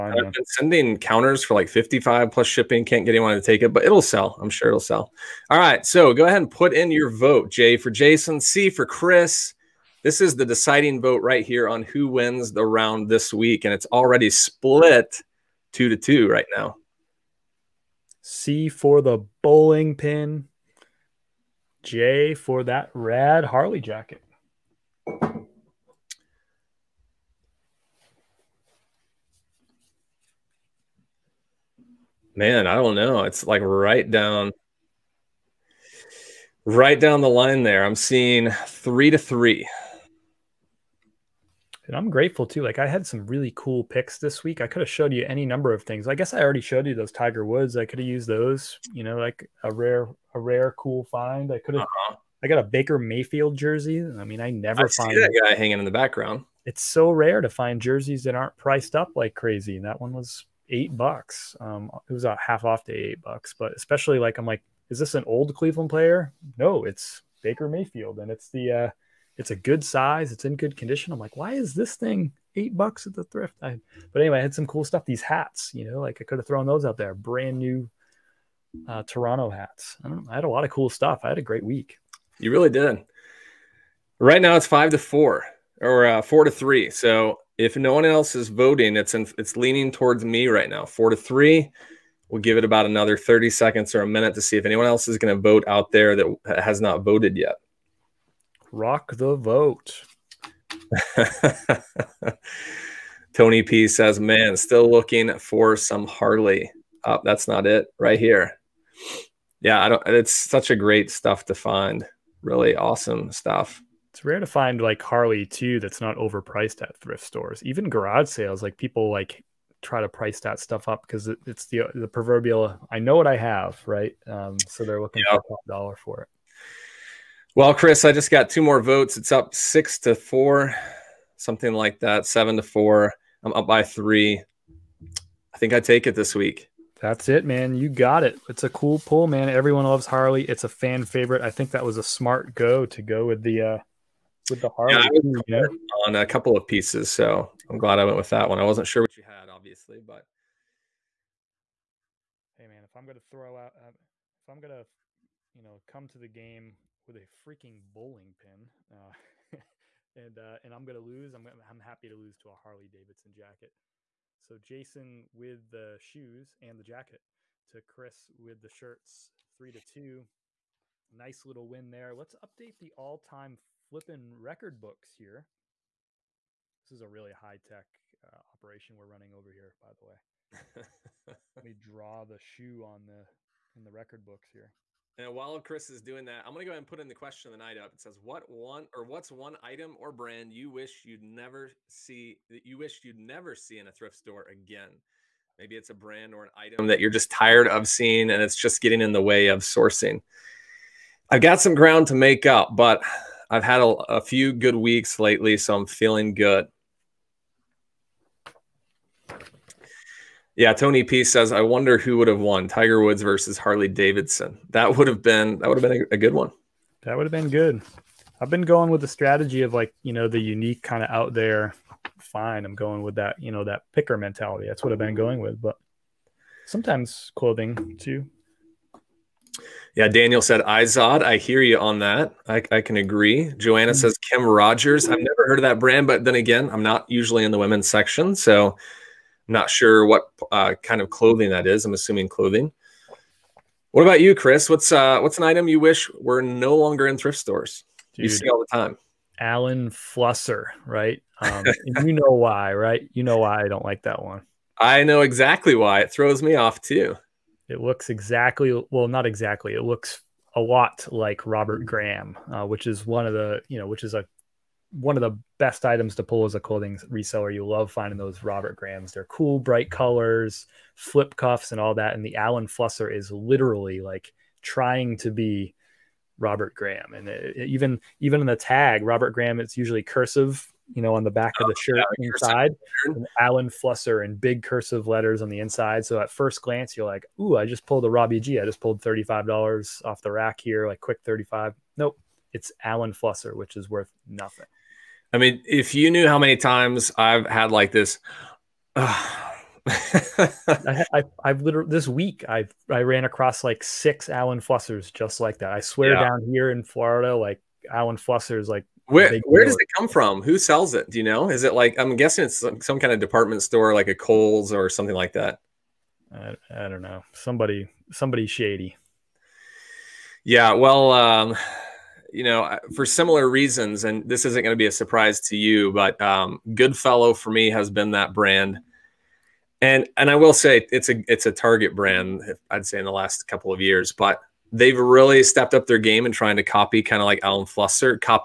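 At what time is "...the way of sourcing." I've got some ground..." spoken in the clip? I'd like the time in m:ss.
3:19.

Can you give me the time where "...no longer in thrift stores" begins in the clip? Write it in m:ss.
4:06.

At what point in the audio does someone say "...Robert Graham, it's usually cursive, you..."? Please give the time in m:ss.
4:39.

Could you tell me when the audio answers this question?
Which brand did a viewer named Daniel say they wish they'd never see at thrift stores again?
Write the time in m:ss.
3:50.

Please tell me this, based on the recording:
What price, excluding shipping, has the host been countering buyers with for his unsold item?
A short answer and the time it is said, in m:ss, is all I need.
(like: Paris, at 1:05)
55, at 0:01.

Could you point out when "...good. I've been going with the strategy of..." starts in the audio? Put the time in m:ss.
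3:37.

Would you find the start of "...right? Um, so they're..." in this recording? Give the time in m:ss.
2:03.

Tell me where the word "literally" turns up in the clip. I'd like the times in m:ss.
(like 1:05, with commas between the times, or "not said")
4:33, 5:01.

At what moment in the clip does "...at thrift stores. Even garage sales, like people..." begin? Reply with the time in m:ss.
1:56.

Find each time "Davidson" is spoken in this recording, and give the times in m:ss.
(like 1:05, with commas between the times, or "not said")
2:42, 3:33.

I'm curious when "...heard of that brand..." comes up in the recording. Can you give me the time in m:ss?
3:55.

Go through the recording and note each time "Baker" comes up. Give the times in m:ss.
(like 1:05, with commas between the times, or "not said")
0:52, 1:07.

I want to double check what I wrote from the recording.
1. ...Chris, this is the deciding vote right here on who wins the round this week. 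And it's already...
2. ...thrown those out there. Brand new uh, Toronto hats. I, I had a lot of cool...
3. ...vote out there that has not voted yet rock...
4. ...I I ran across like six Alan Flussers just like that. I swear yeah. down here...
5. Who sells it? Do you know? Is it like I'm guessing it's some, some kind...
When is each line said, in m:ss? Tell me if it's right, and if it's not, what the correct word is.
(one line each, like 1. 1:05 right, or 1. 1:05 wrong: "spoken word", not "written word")
1. 0:08 right
2. 1:16 right
3. 1:35 right
4. 5:02 right
5. 5:10 right.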